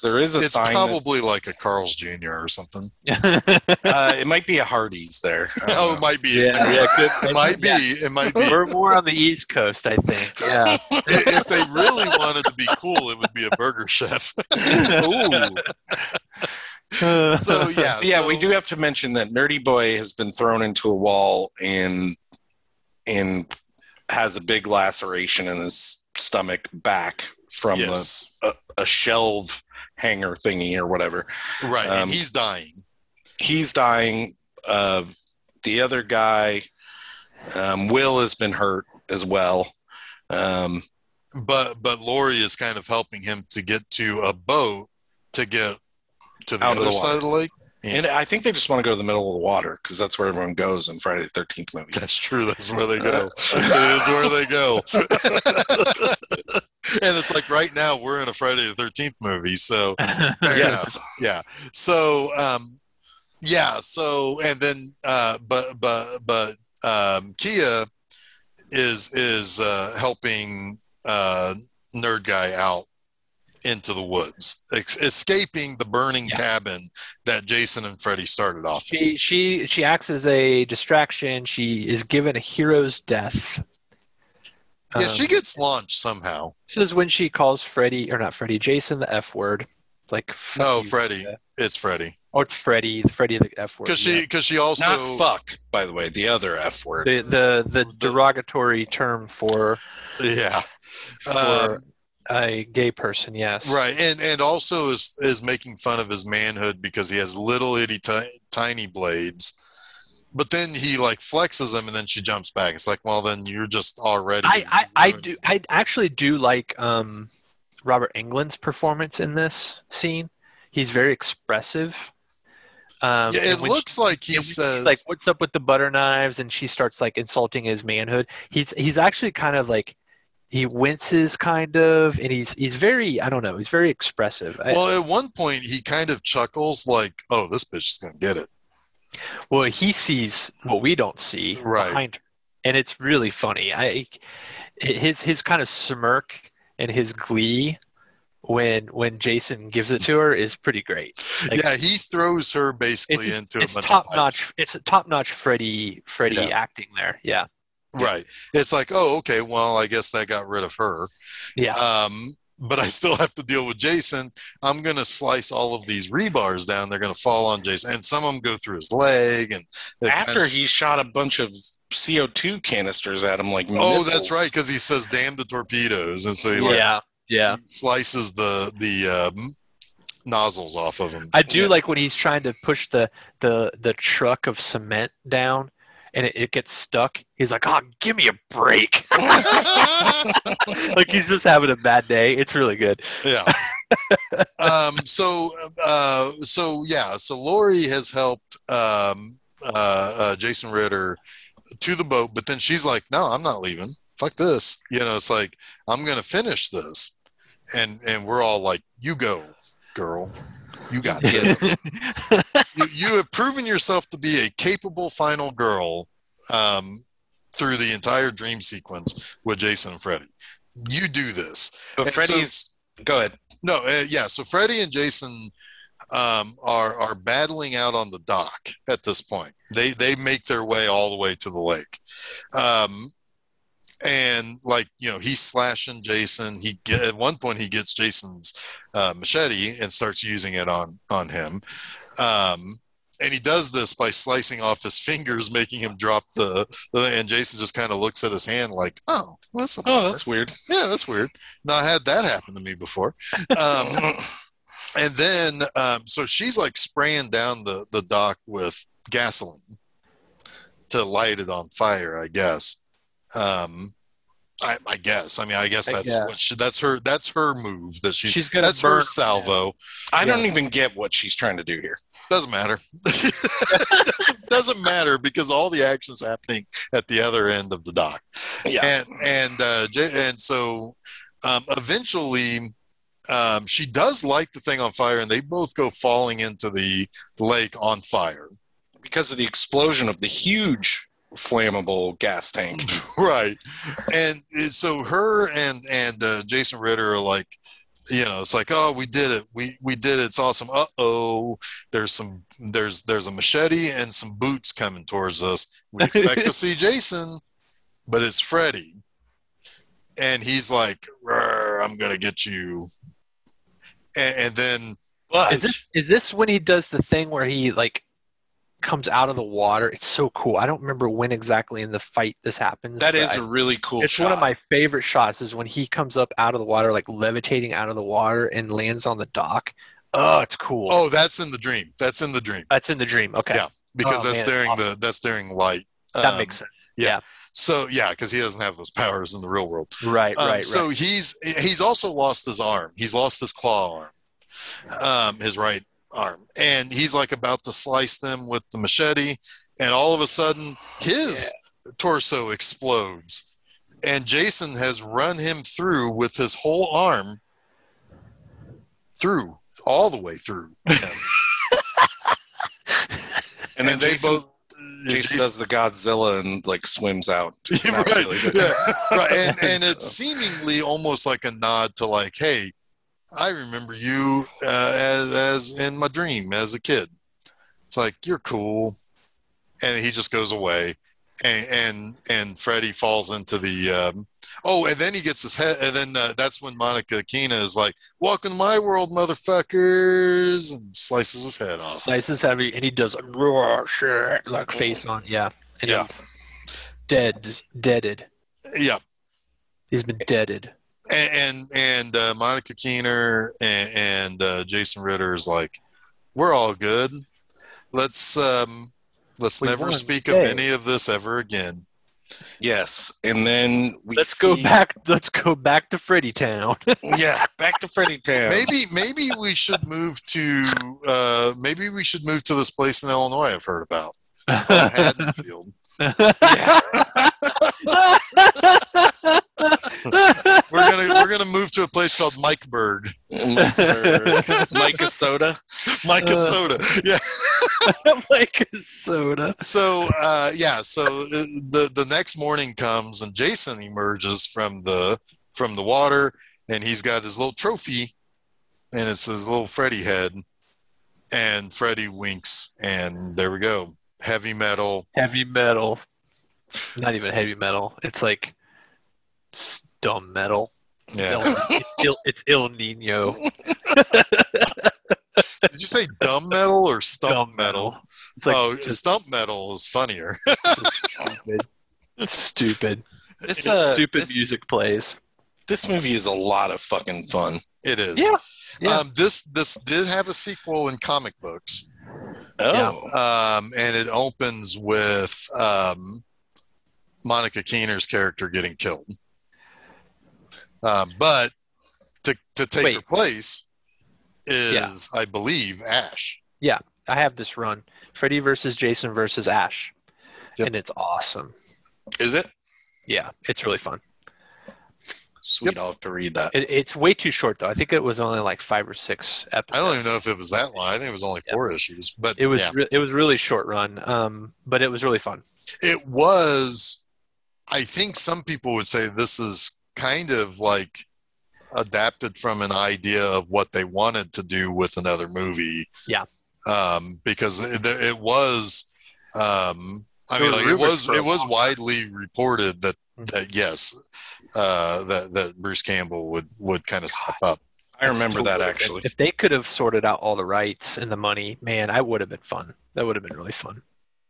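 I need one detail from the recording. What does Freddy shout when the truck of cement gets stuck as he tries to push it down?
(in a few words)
Give me a break.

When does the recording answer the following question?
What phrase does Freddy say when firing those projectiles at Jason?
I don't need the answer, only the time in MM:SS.
02:55.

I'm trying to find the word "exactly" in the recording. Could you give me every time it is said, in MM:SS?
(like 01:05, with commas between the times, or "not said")
05:21.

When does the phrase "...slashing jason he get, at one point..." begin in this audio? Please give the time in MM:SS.
03:55.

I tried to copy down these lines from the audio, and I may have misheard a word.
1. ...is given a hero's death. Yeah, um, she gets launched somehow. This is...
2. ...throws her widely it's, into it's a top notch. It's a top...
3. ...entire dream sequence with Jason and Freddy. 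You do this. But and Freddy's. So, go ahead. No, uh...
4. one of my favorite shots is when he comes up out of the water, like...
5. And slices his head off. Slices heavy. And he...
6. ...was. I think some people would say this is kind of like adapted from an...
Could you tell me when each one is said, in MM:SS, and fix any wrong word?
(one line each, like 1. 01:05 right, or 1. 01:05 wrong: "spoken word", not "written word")
1. 01:21 right
2. 02:31 wrong: "basically", not "widely"
3. 03:37 right
4. 05:24 right
5. 06:30 right
6. 08:36 right.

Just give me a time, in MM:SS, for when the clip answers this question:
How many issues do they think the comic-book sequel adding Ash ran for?
08:31.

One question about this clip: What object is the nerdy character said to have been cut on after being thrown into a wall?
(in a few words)
A shelf hanger.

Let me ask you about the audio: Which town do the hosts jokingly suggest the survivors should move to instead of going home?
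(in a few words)
Haddonfield.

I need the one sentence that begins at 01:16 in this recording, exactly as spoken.
cabin that Jason and Freddy started off.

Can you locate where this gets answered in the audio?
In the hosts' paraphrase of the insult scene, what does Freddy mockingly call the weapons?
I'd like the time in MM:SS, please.
02:05.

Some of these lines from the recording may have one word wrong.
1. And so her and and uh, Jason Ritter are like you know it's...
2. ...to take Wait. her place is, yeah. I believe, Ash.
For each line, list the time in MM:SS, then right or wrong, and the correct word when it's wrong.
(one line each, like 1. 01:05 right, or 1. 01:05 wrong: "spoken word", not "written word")
1. 04:54 right
2. 08:12 right.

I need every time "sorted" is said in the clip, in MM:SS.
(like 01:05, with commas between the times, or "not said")
08:59.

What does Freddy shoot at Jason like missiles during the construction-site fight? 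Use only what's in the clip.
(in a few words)
CO2 canisters.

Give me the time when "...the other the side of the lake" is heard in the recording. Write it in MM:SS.
00:46.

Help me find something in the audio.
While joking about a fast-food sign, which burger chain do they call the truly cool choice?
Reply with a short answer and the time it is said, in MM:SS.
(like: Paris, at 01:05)
Burger Chef, at 00:13.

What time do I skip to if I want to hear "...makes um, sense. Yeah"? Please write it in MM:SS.
05:36.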